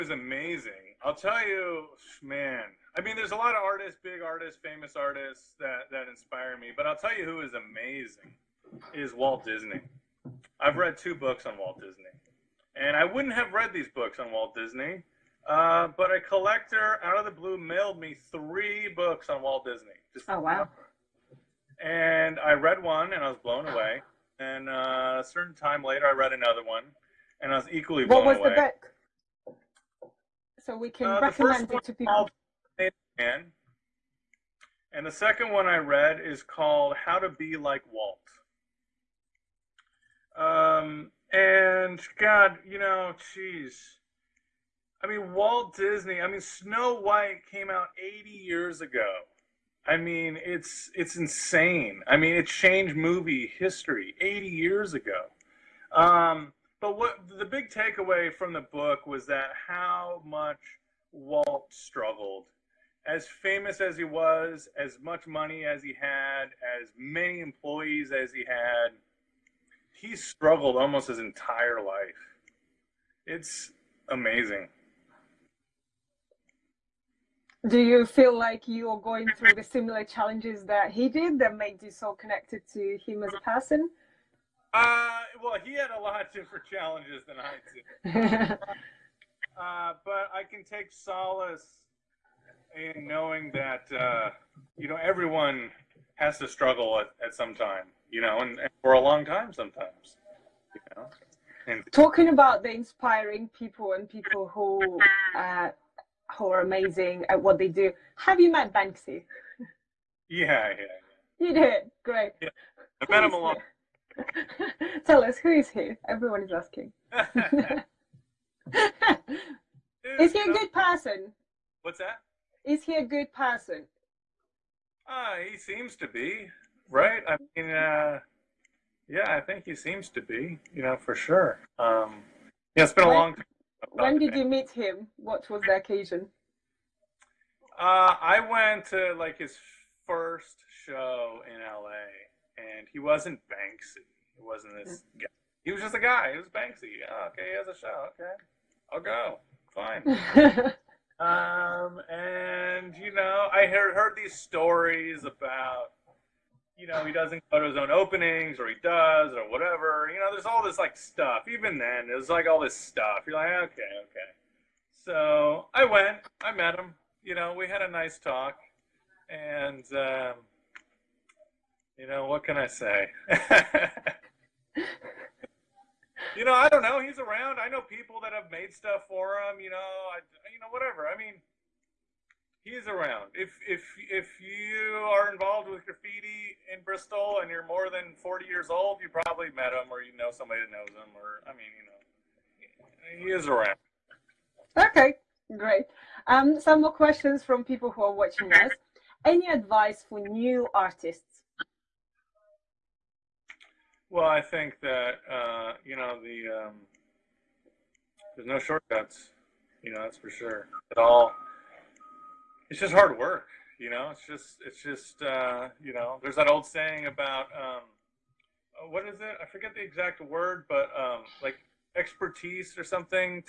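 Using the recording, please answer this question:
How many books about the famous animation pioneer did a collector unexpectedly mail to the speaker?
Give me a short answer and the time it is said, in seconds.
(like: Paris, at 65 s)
3, at 18 s.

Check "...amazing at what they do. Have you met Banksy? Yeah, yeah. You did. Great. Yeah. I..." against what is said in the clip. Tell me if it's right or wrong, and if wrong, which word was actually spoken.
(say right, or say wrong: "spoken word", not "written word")
right.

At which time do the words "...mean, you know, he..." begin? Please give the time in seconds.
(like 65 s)
191 s.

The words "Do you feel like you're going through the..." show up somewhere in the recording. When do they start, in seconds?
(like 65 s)
77 s.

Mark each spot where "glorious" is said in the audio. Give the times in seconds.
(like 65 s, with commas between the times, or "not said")
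not said.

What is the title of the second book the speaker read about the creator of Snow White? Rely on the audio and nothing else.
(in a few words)
How to Be Like Walt.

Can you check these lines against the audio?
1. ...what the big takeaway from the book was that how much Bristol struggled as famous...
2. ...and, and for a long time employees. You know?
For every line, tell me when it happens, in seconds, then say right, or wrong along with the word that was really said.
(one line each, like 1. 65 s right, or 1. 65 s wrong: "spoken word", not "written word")
1. 56 s wrong: "Walt", not "Bristol"
2. 98 s wrong: "sometimes", not "employees".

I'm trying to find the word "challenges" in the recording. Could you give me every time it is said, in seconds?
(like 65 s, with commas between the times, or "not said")
80 s, 86 s.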